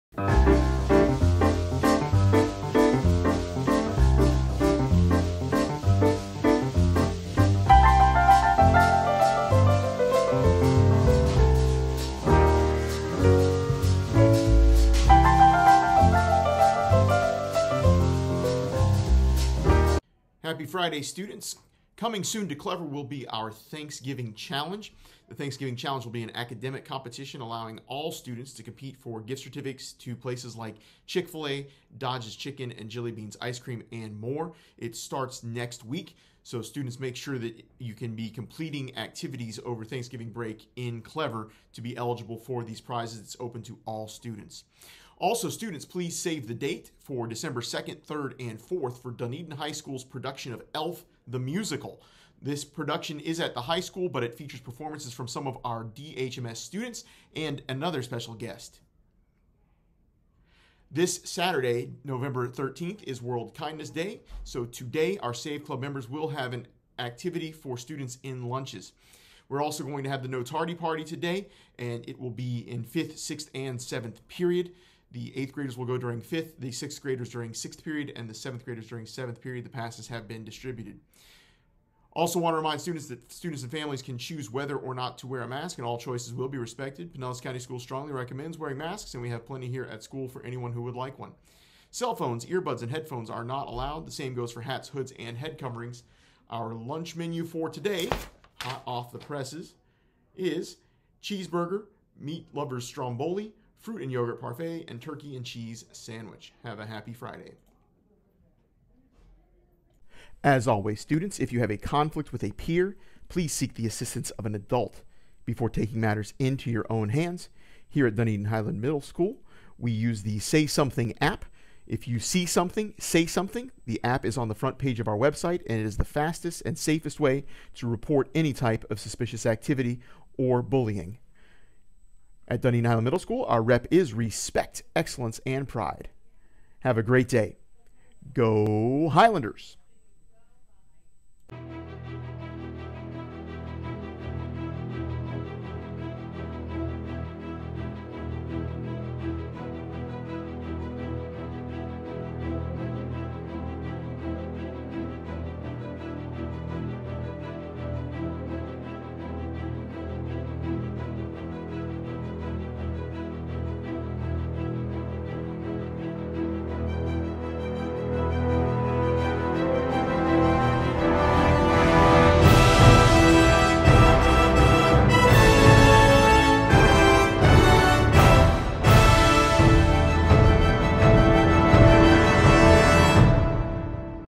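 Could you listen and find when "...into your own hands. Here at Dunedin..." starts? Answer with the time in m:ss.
1:56.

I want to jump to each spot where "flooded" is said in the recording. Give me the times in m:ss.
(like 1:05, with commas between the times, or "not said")
not said.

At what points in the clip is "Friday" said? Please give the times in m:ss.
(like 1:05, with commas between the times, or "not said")
0:20, 1:47.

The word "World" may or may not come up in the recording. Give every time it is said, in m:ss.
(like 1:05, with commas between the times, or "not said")
1:03.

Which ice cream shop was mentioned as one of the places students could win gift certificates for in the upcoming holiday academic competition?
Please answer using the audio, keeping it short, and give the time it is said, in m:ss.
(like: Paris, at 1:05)
Jilly Beans Ice Cream, at 0:32.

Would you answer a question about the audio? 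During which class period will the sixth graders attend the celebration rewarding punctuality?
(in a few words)
6th period.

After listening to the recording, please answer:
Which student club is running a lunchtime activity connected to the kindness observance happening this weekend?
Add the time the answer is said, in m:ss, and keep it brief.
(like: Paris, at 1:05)
Save Club, at 1:05.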